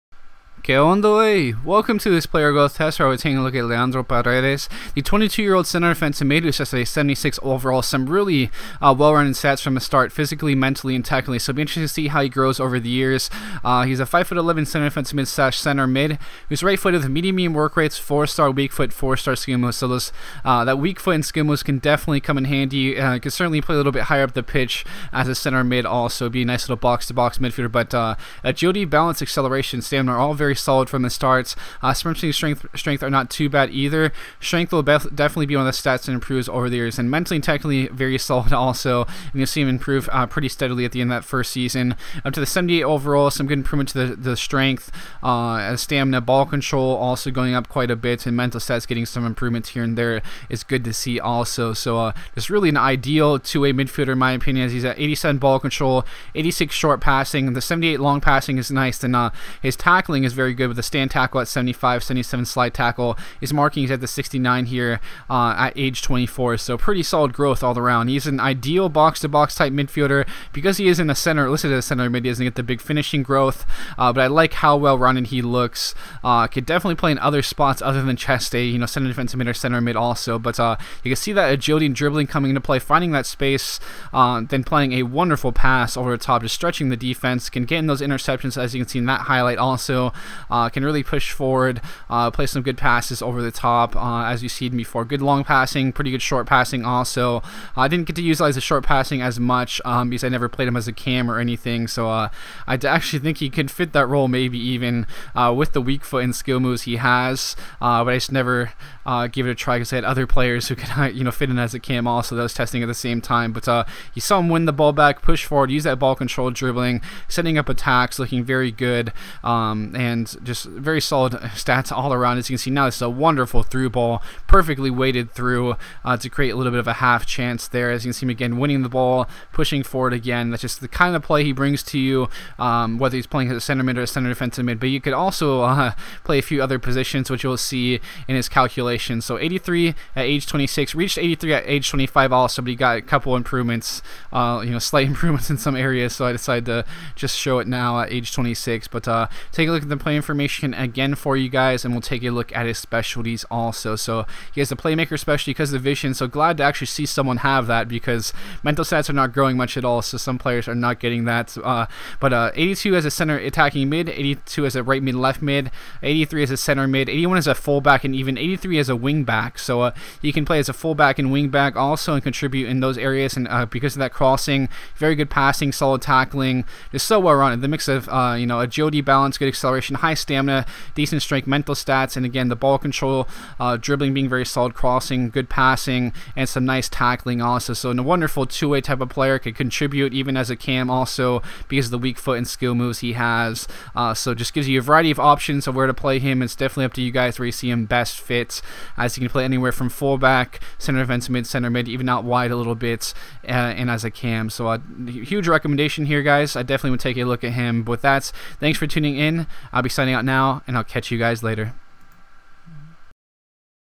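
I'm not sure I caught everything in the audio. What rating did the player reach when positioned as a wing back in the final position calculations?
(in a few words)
83.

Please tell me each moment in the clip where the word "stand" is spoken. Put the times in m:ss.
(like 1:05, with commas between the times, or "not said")
1:00.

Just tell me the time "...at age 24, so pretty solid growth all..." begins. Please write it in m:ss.
1:05.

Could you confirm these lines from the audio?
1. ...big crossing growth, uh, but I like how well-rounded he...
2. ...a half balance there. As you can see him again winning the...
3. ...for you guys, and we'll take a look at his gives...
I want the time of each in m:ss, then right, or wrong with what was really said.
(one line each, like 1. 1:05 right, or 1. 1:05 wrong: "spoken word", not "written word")
1. 1:12 wrong: "finishing", not "crossing"
2. 2:06 wrong: "chance", not "balance"
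3. 2:31 wrong: "specialties", not "gives".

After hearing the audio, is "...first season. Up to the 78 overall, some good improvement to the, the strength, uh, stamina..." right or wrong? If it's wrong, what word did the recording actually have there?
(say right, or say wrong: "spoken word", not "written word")
right.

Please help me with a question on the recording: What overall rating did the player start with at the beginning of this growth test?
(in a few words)
76.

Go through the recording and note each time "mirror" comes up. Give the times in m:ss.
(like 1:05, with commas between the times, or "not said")
not said.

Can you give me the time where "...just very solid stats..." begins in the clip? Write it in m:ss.
2:00.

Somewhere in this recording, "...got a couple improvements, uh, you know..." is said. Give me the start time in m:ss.
2:22.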